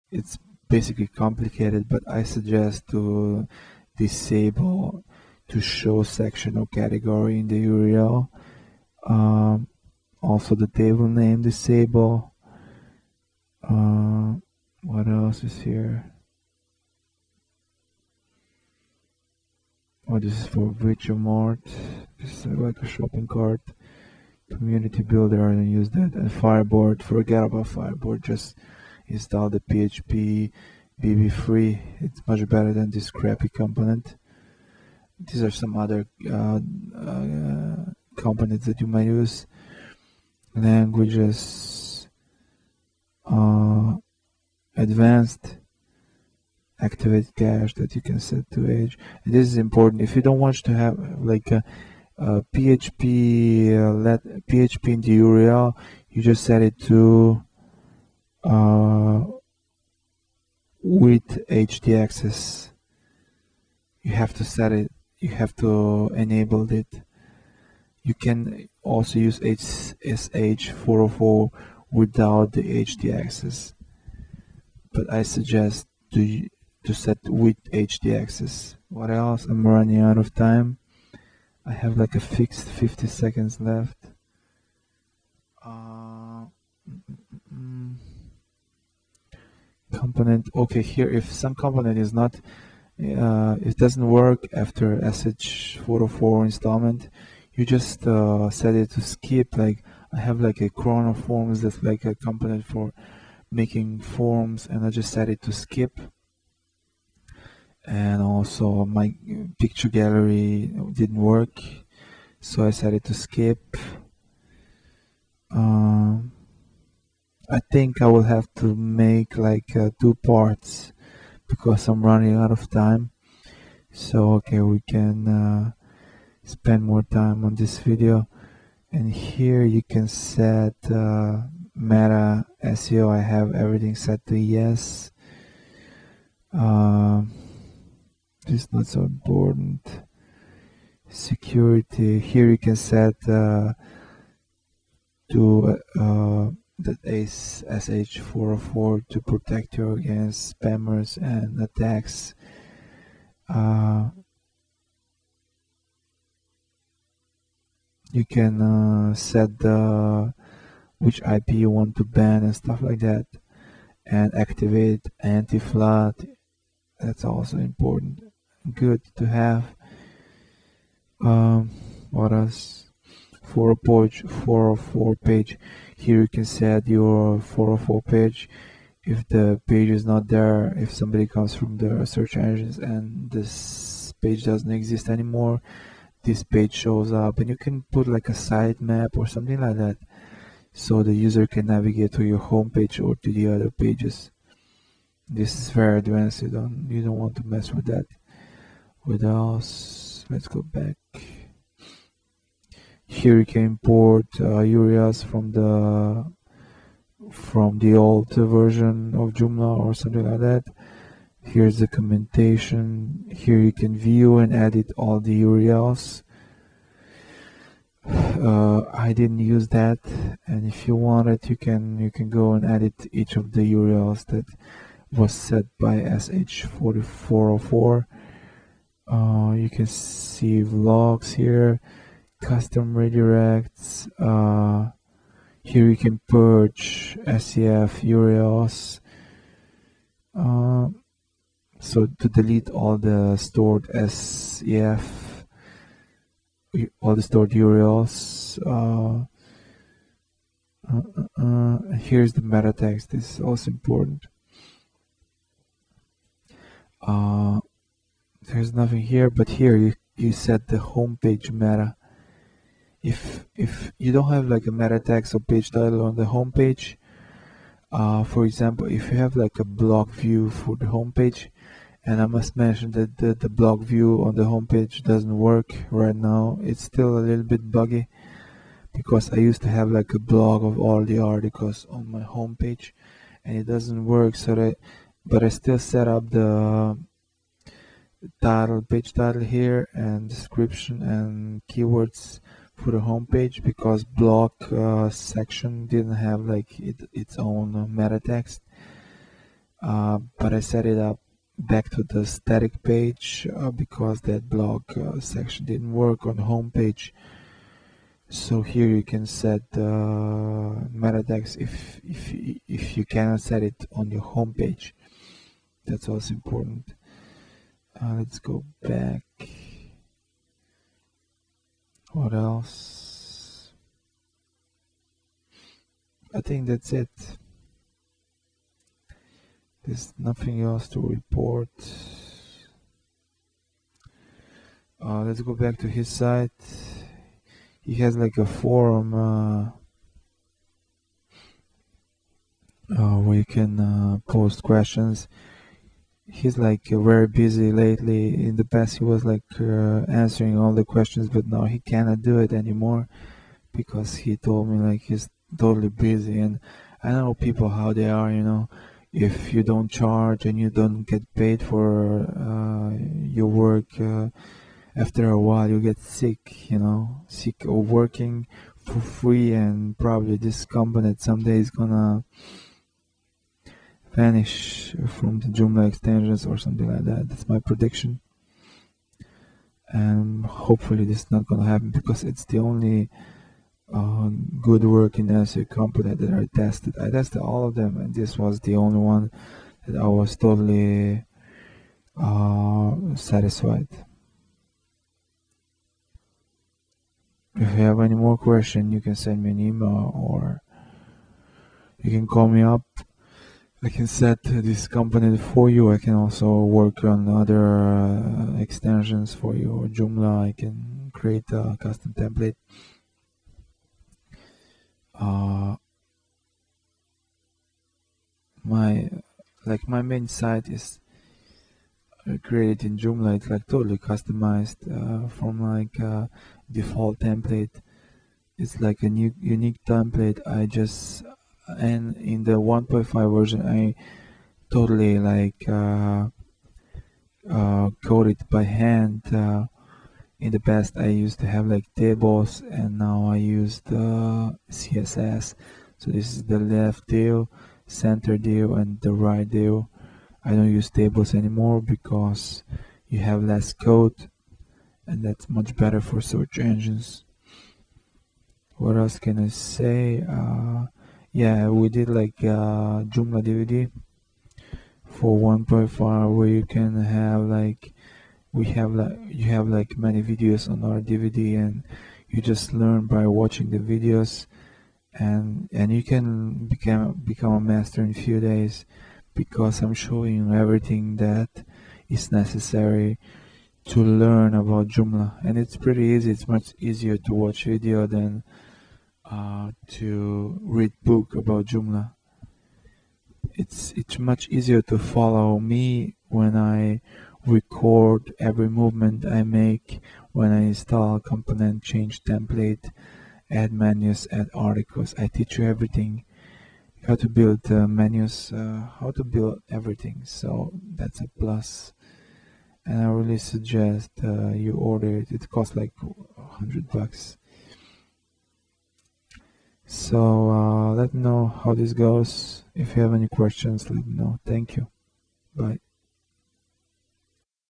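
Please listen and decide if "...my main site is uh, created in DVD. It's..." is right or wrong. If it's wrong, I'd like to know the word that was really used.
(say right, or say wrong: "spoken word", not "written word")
wrong: "Joomla", not "DVD".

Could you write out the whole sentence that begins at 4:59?
Uh, but I set it up back to the static page uh, because that blog uh, section didn't work on the homepage.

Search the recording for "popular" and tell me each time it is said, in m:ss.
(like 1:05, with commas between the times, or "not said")
not said.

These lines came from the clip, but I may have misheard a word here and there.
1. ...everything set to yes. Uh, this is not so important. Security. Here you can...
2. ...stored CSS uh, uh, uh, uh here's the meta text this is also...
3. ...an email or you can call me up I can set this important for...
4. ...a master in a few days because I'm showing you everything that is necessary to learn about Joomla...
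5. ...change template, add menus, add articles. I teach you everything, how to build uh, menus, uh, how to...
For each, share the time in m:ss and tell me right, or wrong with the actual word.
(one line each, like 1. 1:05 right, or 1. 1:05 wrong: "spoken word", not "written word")
1. 2:13 right
2. 4:07 wrong: "URLs", not "CSS"
3. 6:39 wrong: "component", not "important"
4. 7:57 right
5. 8:21 right.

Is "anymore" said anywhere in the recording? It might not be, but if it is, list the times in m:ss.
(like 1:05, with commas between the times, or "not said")
3:05, 5:52, 7:31.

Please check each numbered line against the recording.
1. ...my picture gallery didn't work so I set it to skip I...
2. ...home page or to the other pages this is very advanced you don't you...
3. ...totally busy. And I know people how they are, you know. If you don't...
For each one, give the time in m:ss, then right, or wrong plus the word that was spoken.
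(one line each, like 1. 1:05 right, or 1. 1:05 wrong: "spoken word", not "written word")
1. 1:48 right
2. 3:12 right
3. 5:55 right.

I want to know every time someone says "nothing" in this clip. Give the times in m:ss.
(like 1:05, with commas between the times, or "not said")
4:18, 5:30.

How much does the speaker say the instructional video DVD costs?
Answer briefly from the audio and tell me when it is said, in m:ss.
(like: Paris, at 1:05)
$100, at 8:36.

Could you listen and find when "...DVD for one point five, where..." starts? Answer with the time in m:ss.
7:43.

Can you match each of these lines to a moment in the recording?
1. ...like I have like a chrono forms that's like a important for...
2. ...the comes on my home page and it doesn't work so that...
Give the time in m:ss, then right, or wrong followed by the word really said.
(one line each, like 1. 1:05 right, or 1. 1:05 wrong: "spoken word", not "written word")
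1. 1:39 wrong: "component", not "important"
2. 4:41 wrong: "articles", not "comes".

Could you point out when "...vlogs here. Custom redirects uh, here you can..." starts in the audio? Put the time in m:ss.
3:50.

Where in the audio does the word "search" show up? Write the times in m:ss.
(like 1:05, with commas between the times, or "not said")
3:02, 7:36.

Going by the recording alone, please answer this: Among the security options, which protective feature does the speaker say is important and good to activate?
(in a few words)
anti-flood.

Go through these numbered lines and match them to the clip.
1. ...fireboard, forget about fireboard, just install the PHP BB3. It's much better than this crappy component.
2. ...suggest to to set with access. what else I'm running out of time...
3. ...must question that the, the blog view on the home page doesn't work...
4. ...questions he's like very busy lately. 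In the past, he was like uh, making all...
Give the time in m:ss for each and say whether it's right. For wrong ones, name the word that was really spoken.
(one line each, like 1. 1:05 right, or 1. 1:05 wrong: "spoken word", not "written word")
1. 0:26 right
2. 1:15 right
3. 4:32 wrong: "mention", not "question"
4. 5:44 wrong: "answering", not "making".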